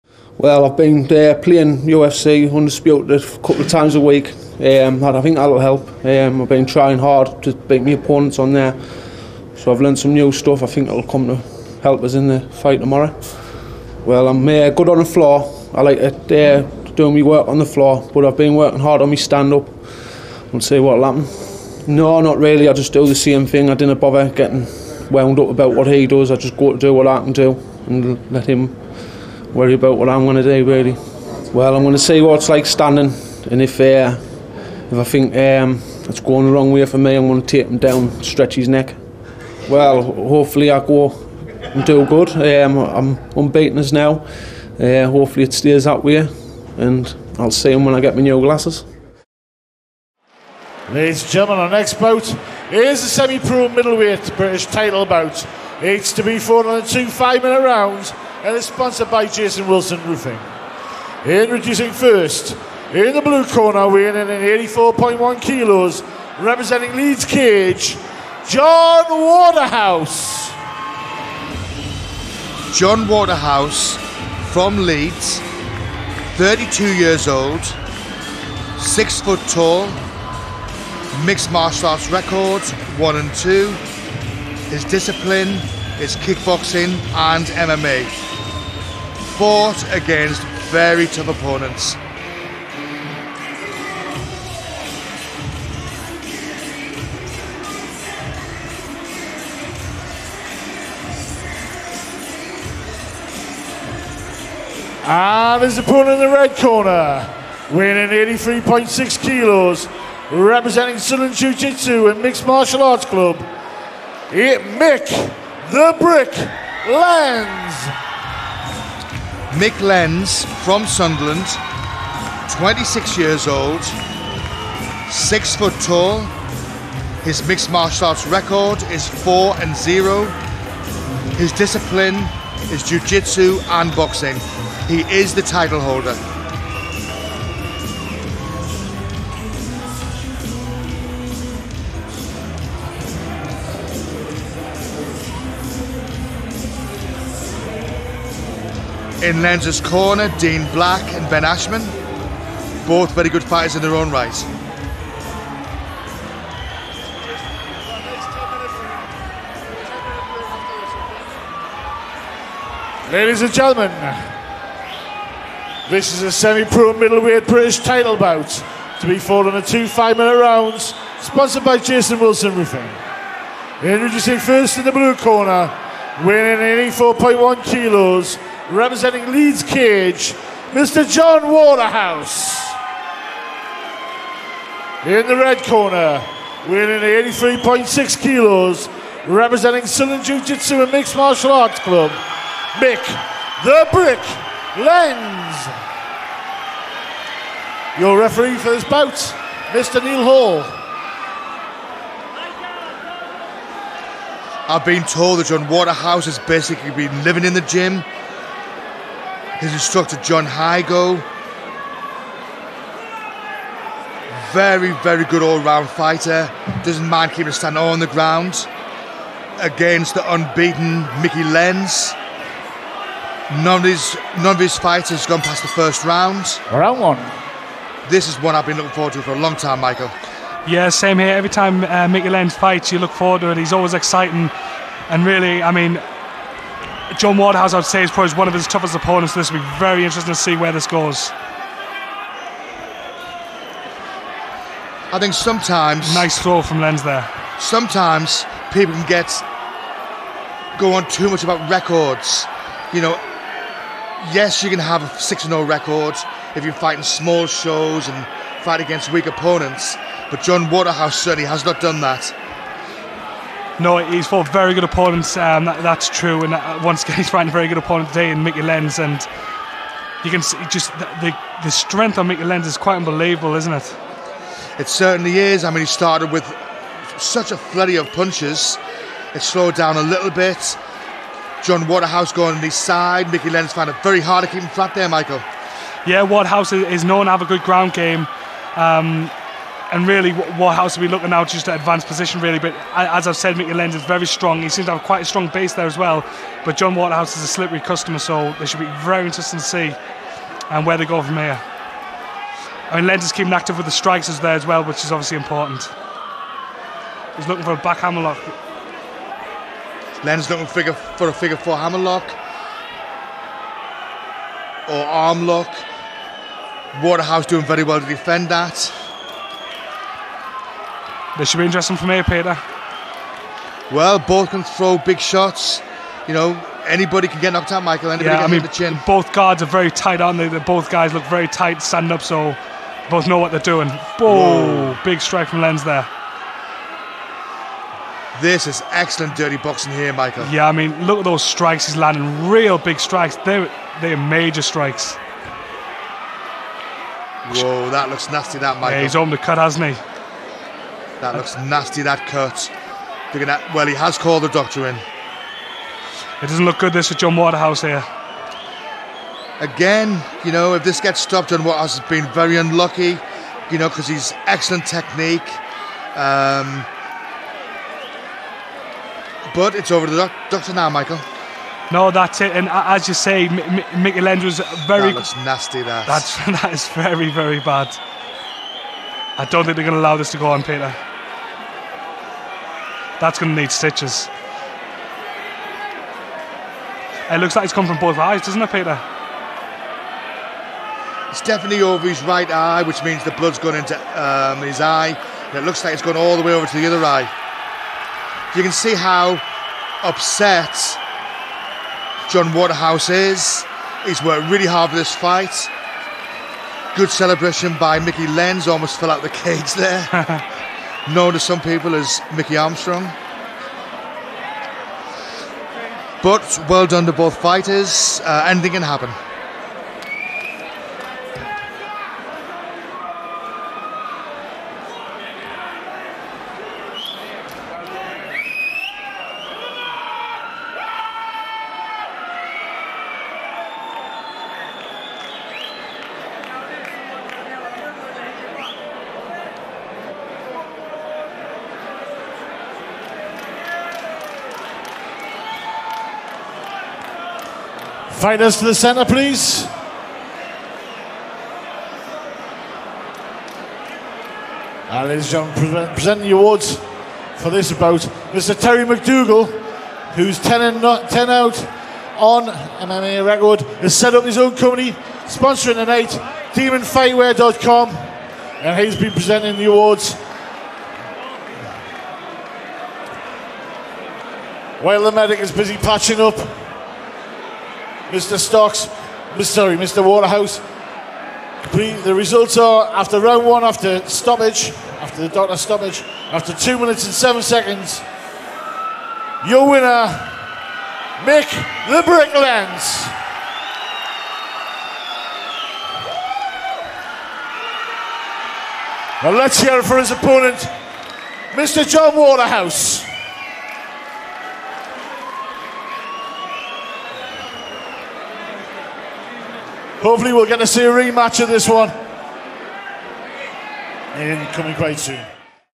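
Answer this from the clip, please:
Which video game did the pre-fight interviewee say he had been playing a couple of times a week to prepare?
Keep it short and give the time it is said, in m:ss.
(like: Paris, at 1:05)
UFC Undisputed, at 0:01.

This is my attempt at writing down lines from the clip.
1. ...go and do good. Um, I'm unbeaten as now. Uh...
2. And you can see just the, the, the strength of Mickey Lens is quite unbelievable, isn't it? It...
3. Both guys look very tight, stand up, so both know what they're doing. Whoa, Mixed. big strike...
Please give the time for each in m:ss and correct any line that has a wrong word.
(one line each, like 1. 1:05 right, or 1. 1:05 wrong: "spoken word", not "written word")
1. 0:40 right
2. 4:28 right
3. 5:30 wrong: "Whoa", not "Mixed".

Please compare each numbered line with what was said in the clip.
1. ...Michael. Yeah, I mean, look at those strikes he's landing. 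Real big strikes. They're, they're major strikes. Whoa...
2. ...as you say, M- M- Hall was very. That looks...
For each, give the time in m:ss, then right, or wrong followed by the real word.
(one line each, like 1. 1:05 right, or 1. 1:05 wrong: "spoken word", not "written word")
1. 5:40 right
2. 6:12 wrong: "Mickey", not "Hall".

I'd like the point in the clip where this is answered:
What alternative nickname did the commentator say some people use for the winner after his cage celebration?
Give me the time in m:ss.
6:52.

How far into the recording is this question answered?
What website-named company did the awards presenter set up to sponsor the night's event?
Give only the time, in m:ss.
7:46.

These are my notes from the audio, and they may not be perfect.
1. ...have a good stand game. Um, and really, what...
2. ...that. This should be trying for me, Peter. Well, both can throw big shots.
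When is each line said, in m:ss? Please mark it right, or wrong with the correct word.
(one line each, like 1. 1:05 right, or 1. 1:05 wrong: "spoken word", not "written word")
1. 4:47 wrong: "ground", not "stand"
2. 5:18 wrong: "interesting", not "trying".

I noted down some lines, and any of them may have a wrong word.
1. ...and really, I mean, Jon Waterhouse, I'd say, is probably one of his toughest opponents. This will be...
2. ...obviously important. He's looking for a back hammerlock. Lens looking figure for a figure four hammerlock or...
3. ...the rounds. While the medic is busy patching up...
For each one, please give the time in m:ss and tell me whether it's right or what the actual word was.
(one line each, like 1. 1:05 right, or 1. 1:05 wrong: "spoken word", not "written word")
1. 3:55 right
2. 5:05 right
3. 7:49 wrong: "awards", not "rounds".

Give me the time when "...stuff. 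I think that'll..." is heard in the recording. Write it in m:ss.
0:10.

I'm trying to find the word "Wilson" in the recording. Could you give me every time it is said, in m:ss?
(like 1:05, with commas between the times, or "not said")
0:59, 2:52.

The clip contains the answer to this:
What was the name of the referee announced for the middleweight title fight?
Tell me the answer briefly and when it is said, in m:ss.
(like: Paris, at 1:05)
Neil Hall, at 3:20.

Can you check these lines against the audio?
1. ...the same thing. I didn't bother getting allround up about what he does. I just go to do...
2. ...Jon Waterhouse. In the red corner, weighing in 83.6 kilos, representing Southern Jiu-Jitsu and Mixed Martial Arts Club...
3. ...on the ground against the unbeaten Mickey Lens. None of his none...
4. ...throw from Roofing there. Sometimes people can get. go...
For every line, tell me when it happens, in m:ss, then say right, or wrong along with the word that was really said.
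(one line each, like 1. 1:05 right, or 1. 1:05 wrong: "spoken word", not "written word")
1. 0:23 wrong: "wound", not "allround"
2. 3:01 right
3. 3:37 right
4. 4:06 wrong: "Lens", not "Roofing".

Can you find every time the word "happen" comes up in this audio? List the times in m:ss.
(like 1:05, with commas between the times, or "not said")
0:21, 6:58.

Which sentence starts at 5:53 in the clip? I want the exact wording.
gonna, well, he has called the doctor in.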